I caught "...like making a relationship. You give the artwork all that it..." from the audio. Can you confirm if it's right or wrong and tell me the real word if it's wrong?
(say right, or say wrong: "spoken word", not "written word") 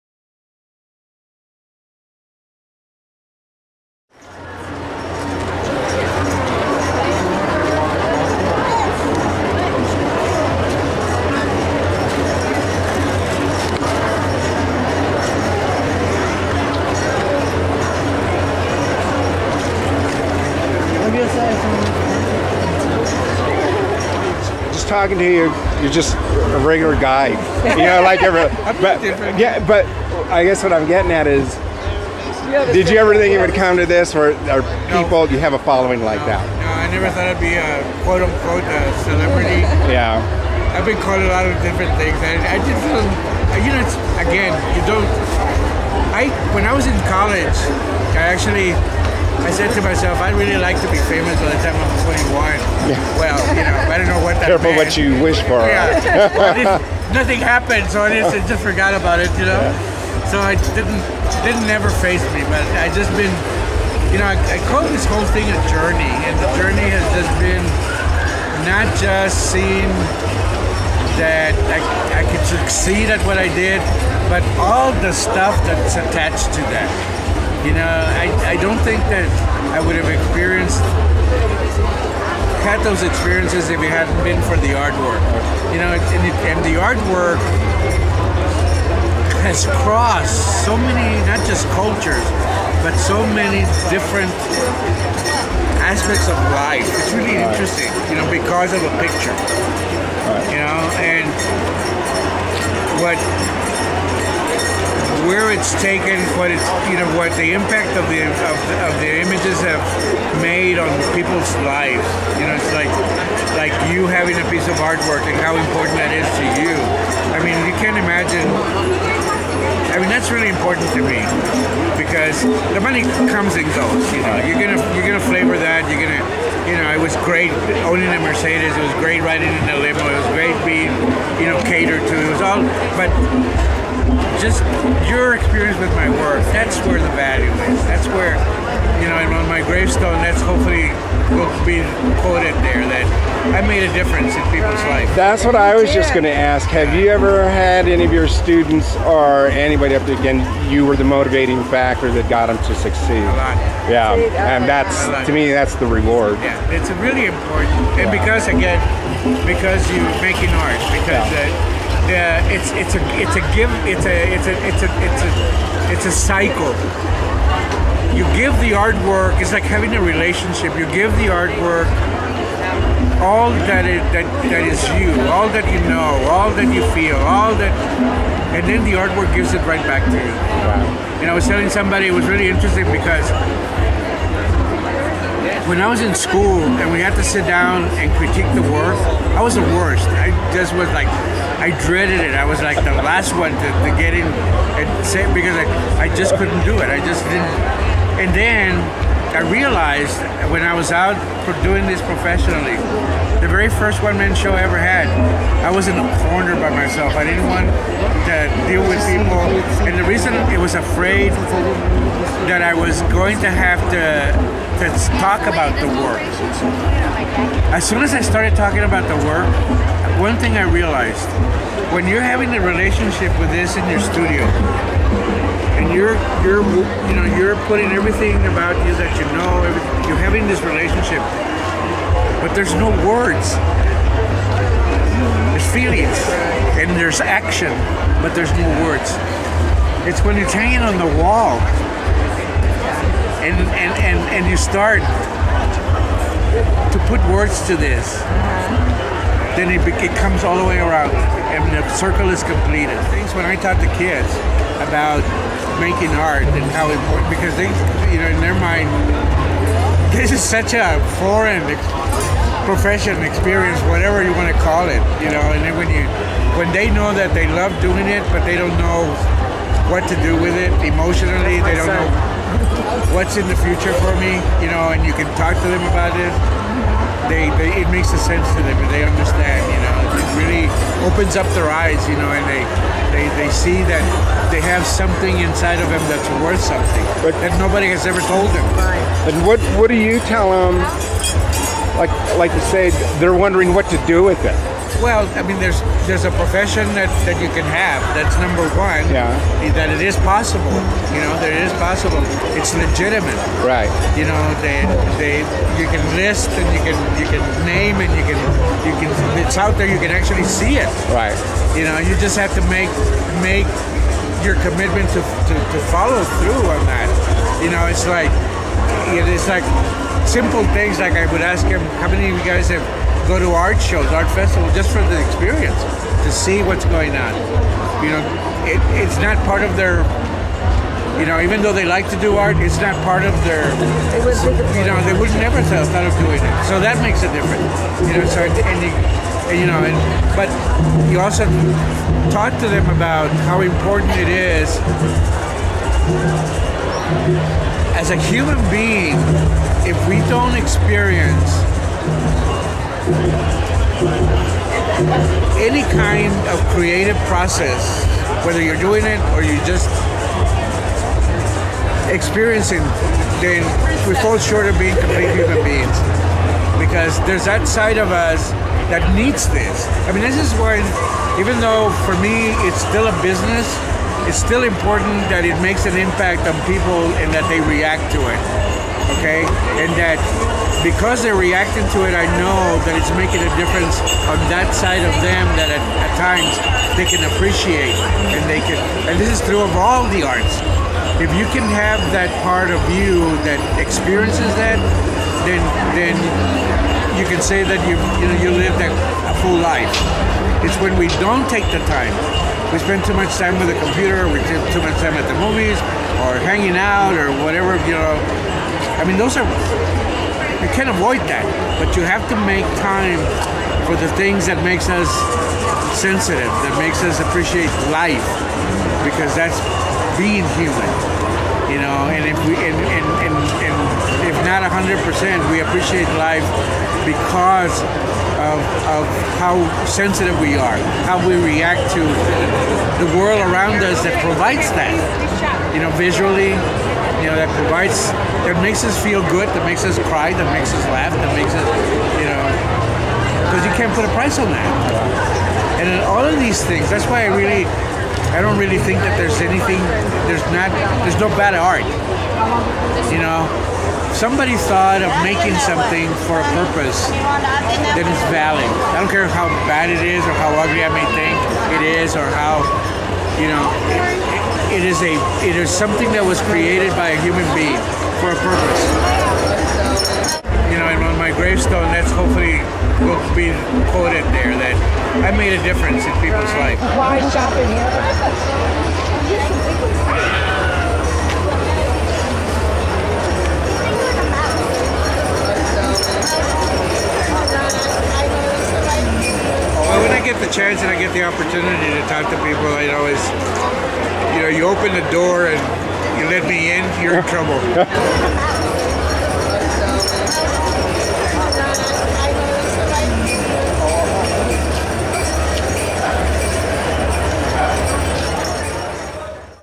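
wrong: "having", not "making".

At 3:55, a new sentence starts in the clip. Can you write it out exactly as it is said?
There's feelings and there's action, but there's no words.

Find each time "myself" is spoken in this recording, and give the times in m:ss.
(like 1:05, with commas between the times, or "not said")
0:49, 3:26.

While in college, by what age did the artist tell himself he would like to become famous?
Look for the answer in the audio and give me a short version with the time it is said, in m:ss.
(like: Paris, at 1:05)
21, at 0:52.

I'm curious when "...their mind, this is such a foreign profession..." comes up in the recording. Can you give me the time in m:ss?
4:18.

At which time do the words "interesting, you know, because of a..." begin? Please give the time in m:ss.
1:37.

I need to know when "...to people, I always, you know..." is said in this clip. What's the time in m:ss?
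8:12.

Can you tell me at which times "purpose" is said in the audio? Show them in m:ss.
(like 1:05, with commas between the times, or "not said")
7:36, 7:48.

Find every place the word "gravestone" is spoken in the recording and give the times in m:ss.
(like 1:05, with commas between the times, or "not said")
2:19, 7:51.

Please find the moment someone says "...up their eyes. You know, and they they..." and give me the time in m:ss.
4:41.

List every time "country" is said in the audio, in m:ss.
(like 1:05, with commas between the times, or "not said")
not said.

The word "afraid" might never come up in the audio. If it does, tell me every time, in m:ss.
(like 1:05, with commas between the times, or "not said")
3:30.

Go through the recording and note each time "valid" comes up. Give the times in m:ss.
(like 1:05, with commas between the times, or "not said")
7:38.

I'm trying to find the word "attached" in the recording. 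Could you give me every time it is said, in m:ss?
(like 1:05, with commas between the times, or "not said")
1:15.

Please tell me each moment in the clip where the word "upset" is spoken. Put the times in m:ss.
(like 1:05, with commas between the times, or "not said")
not said.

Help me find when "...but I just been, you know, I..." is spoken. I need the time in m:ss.
1:02.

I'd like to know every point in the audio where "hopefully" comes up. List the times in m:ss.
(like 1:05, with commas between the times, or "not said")
2:20, 7:52.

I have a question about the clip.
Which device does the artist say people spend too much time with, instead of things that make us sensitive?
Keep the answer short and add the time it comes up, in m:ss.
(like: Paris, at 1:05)
Computer, at 6:43.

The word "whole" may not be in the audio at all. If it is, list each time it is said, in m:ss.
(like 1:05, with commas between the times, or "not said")
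1:05.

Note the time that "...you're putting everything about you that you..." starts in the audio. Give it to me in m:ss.
3:47.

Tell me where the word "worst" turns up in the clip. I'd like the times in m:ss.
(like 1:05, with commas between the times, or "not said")
3:09.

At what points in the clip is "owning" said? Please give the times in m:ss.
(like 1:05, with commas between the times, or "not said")
2:07.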